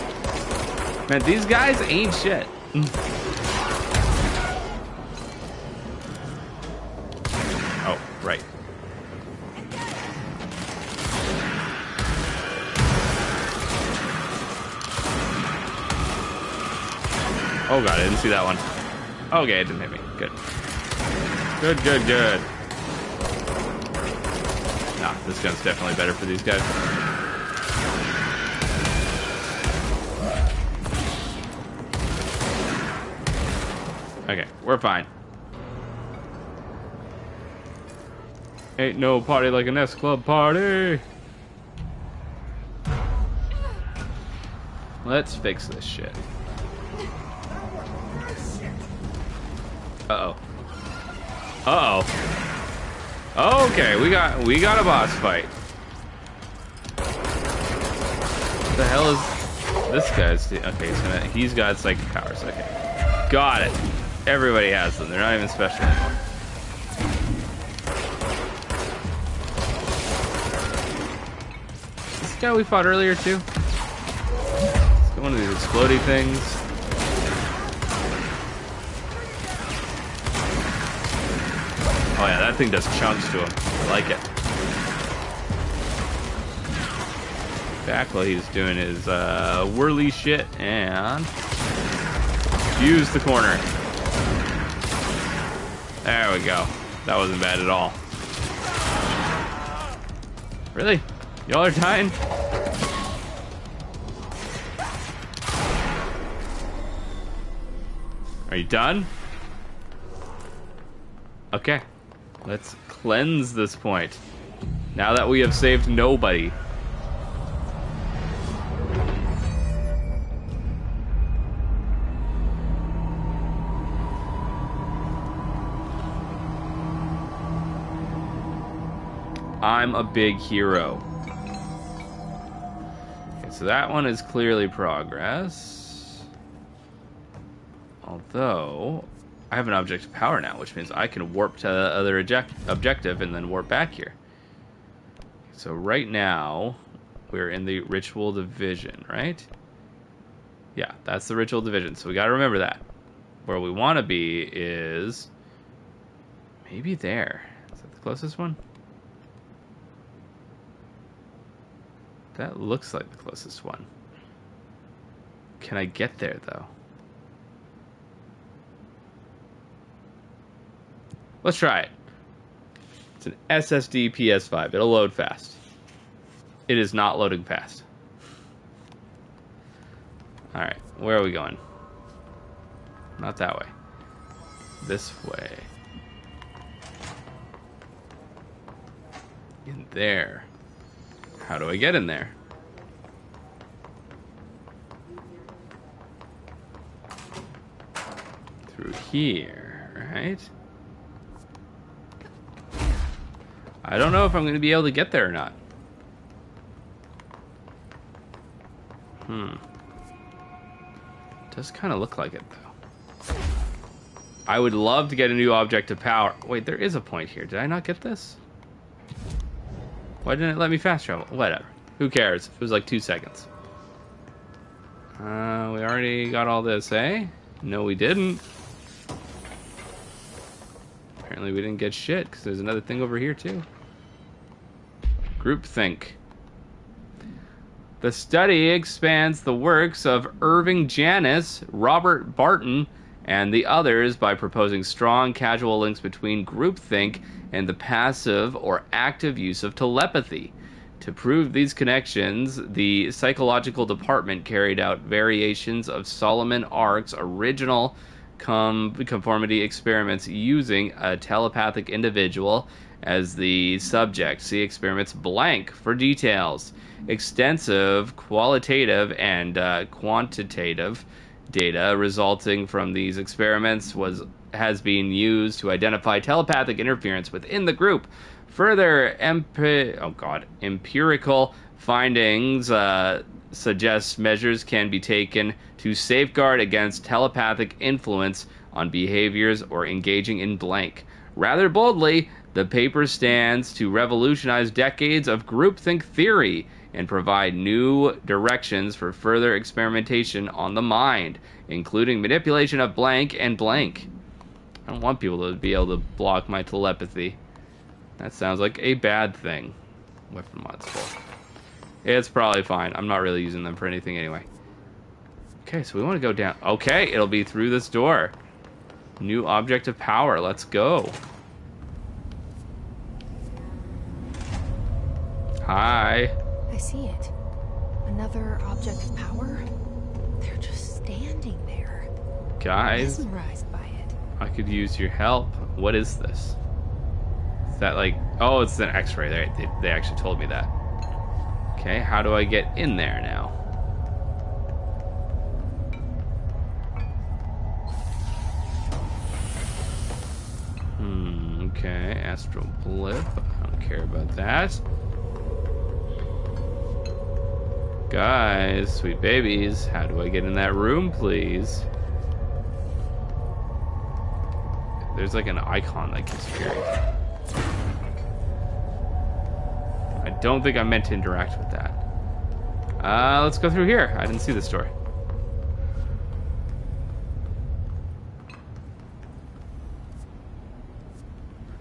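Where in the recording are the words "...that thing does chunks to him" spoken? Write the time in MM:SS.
01:22.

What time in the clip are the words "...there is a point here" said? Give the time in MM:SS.
03:36.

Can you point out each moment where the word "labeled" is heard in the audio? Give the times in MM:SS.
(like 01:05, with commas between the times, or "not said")
not said.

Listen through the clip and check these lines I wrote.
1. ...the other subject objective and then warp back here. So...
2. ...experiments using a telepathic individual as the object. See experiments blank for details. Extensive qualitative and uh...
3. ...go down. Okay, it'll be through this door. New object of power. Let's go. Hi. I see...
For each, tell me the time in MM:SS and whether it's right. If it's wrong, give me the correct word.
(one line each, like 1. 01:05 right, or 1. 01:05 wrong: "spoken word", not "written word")
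1. 02:21 wrong: "object", not "subject"
2. 04:19 wrong: "subject", not "object"
3. 05:16 right.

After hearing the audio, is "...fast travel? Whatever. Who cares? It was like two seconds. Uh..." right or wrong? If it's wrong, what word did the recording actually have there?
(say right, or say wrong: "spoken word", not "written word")
right.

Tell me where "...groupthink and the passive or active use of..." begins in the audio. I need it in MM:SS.
04:06.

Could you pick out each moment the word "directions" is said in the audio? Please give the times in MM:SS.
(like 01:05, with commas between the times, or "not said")
04:58.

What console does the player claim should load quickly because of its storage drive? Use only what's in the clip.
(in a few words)
SSD PS5.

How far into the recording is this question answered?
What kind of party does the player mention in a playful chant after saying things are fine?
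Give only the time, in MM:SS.
00:39.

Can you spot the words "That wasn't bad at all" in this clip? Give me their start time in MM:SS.
01:37.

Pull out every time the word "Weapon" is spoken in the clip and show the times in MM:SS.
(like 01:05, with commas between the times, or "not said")
05:10.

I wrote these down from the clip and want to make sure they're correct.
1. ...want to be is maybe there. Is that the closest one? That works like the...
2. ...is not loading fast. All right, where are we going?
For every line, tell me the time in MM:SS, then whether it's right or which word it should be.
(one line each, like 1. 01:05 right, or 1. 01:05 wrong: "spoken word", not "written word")
1. 02:33 wrong: "looks", not "works"
2. 02:56 right.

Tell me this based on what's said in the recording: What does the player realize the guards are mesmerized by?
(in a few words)
an x-ray.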